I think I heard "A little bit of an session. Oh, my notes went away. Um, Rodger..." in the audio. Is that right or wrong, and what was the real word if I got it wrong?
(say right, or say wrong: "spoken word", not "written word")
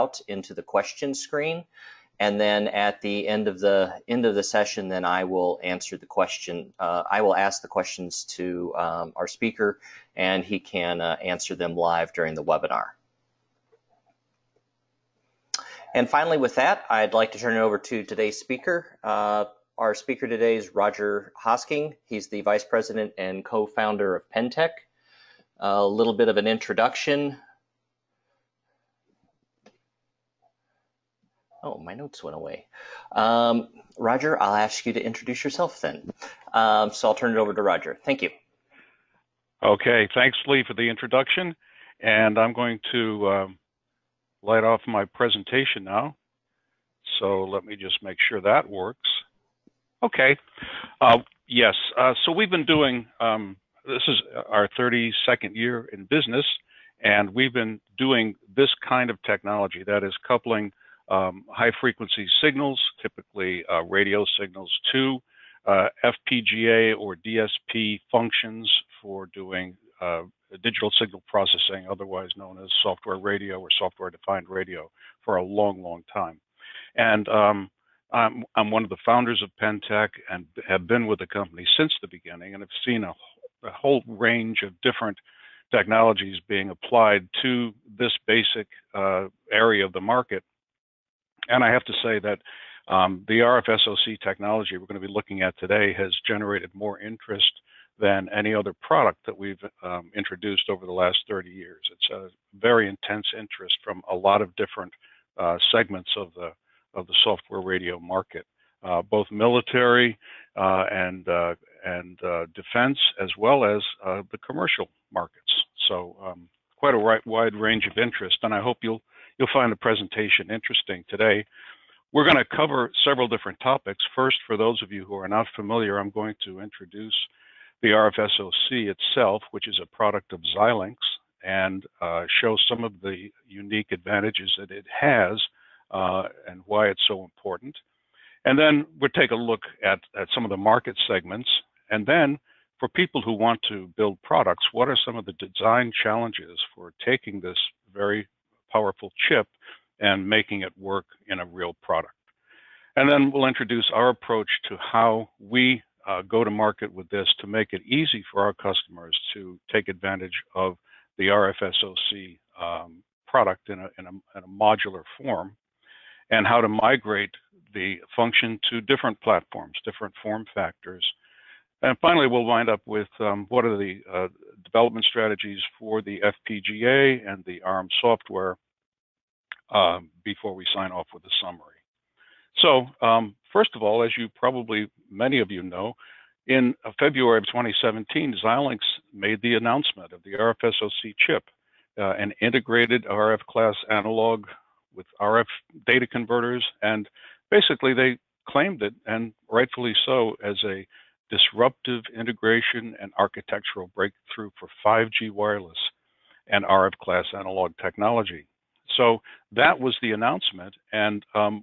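wrong: "introduction", not "session".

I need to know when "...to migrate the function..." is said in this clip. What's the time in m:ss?
2:46.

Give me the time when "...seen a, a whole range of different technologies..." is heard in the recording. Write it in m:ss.
1:22.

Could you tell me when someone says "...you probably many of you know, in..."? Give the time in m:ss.
3:04.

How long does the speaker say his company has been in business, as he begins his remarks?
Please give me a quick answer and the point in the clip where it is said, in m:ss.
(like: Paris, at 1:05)
32nd year, at 0:54.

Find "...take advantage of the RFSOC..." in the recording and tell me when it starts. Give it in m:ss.
2:39.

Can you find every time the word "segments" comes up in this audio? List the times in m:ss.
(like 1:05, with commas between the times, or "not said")
1:45, 2:21.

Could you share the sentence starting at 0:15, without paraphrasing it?
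And finally, with that, I'd like to turn it over to today's speaker.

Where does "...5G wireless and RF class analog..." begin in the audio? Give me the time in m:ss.
3:24.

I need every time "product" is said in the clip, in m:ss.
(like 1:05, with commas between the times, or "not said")
1:38, 2:09, 2:24, 2:31, 2:43.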